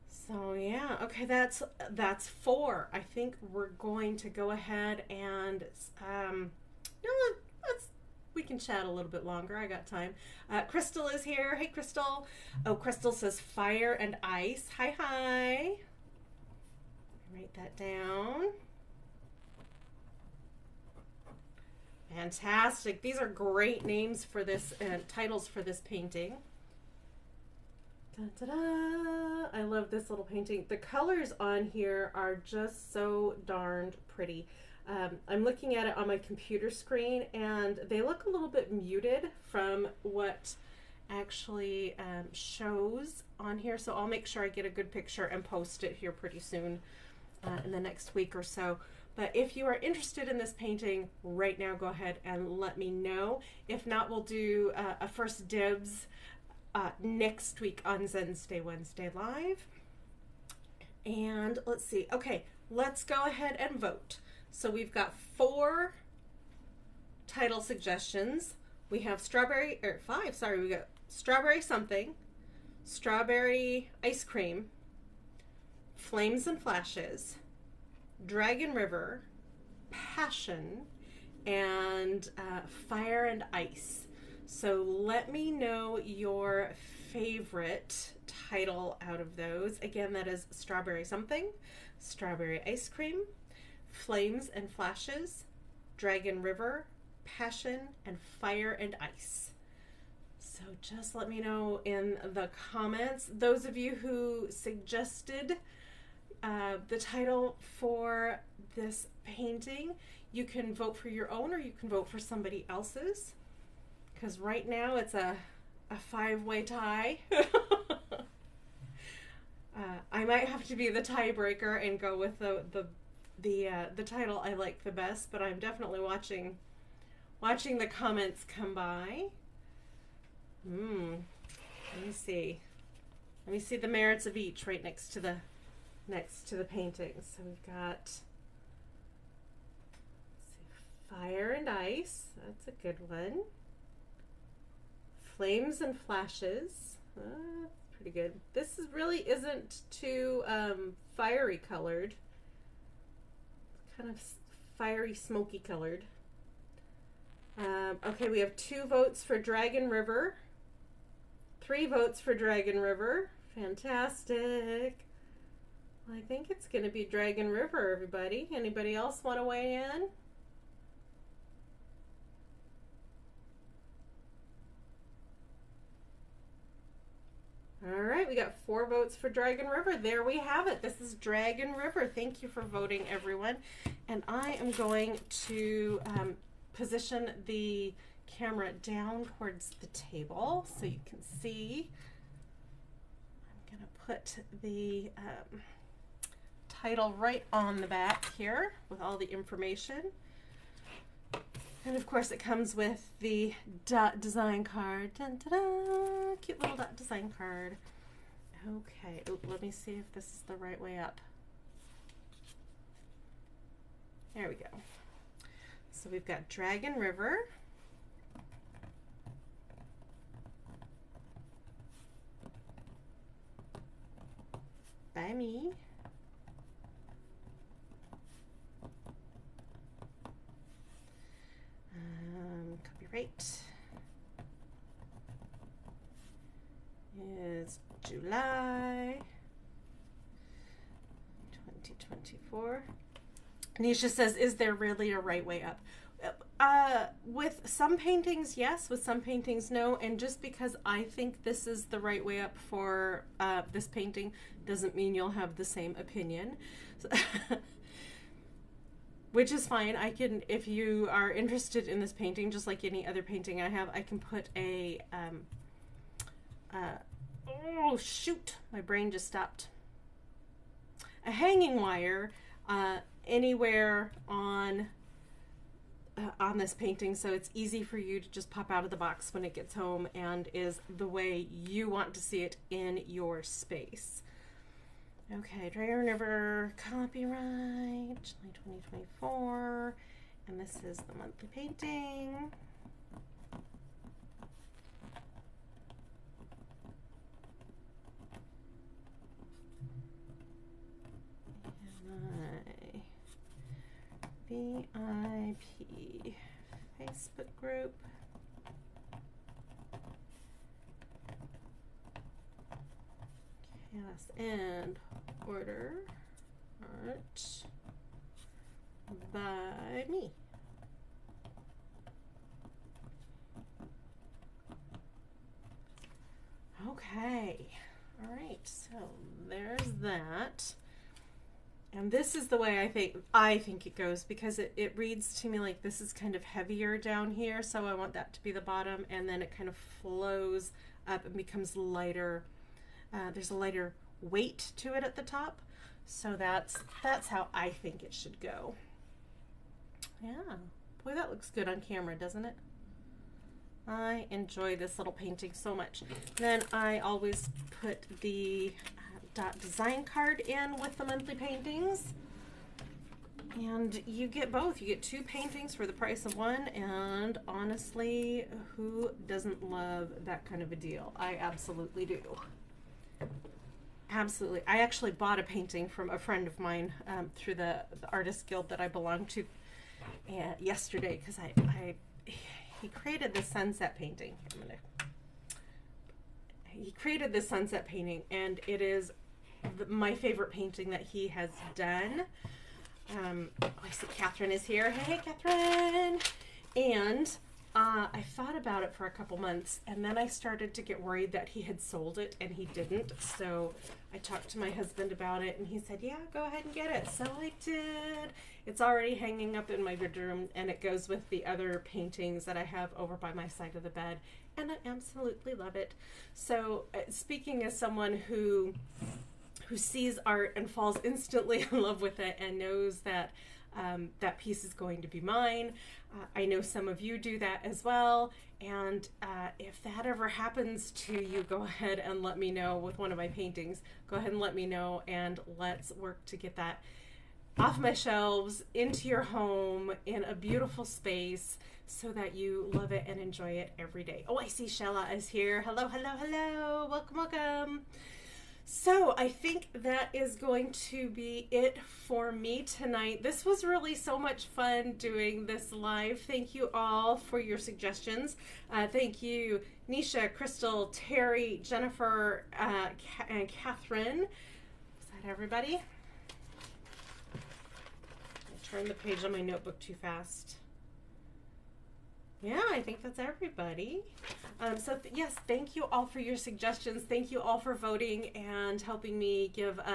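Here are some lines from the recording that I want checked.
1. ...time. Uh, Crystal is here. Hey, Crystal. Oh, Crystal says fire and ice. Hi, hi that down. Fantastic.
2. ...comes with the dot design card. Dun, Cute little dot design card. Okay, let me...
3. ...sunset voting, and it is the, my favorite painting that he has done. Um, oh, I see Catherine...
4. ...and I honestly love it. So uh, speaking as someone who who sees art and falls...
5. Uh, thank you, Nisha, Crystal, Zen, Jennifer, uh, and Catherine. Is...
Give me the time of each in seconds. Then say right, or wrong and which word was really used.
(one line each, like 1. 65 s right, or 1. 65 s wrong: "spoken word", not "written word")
1. 9 s right
2. 202 s right
3. 387 s wrong: "painting", not "voting"
4. 414 s wrong: "absolutely", not "honestly"
5. 458 s wrong: "Terry", not "Zen".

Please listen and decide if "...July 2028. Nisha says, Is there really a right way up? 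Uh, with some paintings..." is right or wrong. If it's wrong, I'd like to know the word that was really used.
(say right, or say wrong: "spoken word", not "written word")
wrong: "2024", not "2028".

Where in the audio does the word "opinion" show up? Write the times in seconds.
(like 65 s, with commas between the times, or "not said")
255 s.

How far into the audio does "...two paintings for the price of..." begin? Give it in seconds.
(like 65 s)
365 s.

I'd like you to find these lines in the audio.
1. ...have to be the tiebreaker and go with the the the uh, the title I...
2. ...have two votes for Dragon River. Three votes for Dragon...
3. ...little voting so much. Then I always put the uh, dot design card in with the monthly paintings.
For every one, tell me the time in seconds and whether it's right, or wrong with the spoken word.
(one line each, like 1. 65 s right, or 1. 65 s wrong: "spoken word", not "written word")
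1. 120 s right
2. 158 s right
3. 354 s wrong: "painting", not "voting".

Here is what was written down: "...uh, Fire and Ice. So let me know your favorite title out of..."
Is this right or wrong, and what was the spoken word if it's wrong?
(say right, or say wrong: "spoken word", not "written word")
right.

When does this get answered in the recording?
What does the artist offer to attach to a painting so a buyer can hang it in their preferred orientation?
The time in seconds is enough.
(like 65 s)
271 s.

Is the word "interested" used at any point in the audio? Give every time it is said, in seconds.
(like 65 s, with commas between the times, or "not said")
49 s, 261 s.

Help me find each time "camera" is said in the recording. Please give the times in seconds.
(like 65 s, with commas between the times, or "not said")
188 s, 351 s.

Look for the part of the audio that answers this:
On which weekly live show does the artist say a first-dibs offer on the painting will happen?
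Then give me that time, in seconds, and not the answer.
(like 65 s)
58 s.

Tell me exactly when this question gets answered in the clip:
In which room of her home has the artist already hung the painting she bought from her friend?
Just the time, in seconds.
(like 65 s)
409 s.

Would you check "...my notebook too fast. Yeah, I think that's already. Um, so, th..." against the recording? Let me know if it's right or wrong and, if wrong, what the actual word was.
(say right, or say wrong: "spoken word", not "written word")
wrong: "everybody", not "already".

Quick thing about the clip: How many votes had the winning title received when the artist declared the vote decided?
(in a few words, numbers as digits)
4.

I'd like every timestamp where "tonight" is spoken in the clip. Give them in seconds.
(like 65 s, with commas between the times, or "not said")
452 s.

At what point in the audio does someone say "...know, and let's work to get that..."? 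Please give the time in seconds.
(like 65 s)
434 s.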